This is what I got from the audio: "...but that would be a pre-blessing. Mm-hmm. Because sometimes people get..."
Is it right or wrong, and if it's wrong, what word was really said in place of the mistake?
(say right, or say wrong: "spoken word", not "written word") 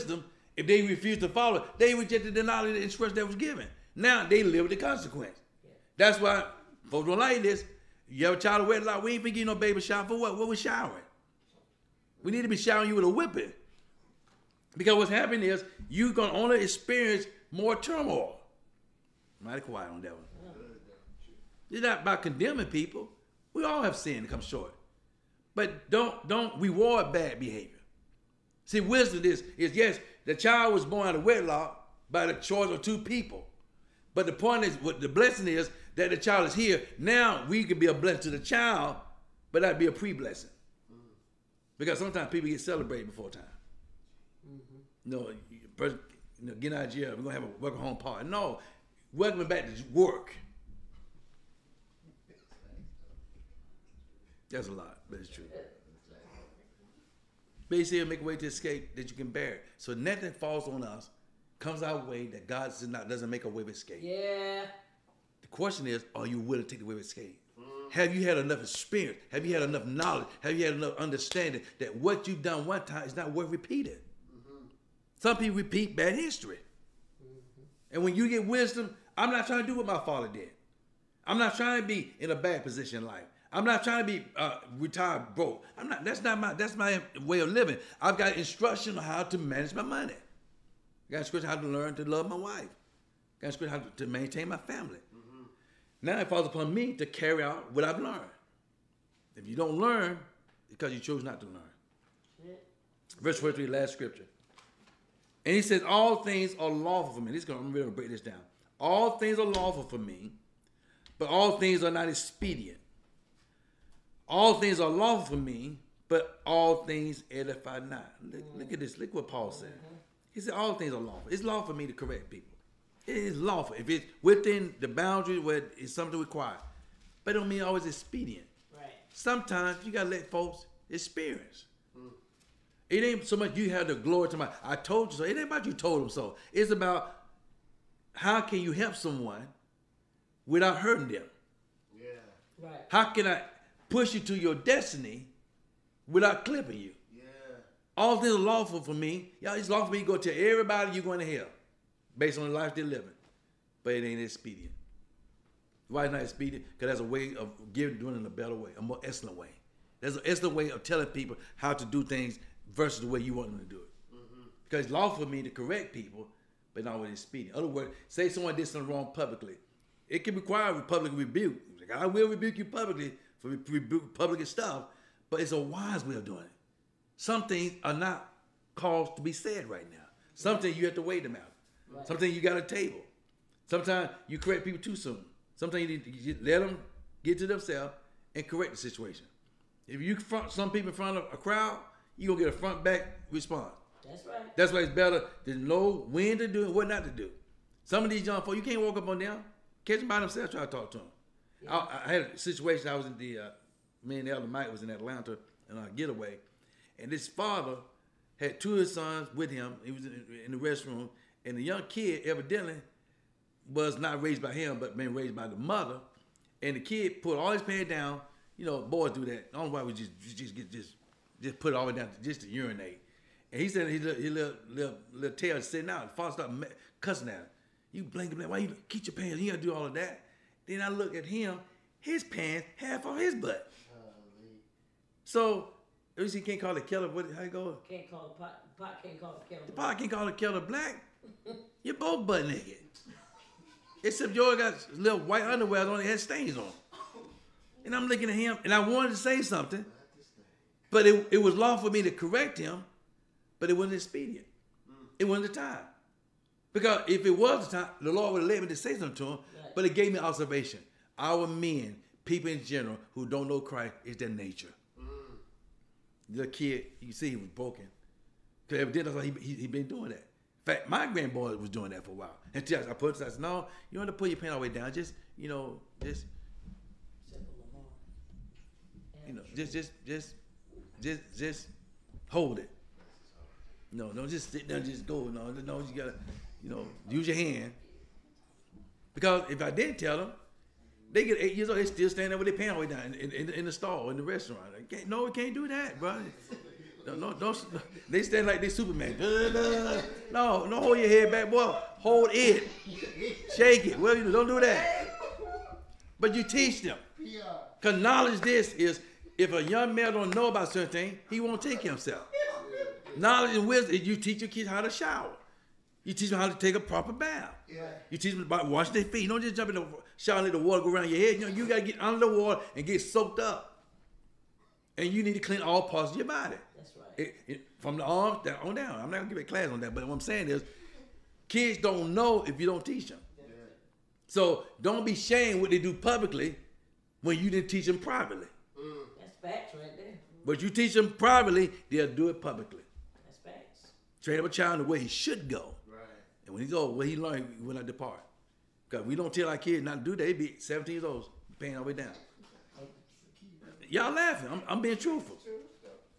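right.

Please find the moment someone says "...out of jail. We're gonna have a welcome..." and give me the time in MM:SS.
00:46.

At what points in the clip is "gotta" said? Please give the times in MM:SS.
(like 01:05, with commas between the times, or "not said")
02:09, 03:49, 04:45, 05:21.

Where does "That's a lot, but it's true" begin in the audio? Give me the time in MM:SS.
00:54.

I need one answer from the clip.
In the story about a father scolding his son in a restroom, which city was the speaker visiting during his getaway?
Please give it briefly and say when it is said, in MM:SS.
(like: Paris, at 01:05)
Atlanta, at 03:24.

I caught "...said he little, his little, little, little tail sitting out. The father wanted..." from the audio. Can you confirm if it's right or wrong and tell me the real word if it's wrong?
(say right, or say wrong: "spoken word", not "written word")
wrong: "started", not "wanted".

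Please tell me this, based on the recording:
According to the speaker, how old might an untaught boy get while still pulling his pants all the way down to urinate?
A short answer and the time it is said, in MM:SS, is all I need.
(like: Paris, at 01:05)
8, at 04:51.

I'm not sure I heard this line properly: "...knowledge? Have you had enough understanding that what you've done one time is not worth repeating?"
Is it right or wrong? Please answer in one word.
right.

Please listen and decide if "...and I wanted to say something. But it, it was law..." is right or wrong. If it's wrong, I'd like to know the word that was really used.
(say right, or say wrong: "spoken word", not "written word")
right.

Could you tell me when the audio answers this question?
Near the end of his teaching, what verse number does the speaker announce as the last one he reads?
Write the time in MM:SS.
01:43.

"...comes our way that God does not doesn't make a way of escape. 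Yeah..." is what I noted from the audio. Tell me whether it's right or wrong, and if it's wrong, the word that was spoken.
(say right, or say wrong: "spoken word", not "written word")
right.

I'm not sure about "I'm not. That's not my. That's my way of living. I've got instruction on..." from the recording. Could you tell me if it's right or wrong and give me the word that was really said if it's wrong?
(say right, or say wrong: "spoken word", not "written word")
right.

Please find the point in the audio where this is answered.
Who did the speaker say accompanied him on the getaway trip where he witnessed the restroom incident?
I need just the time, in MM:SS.
03:24.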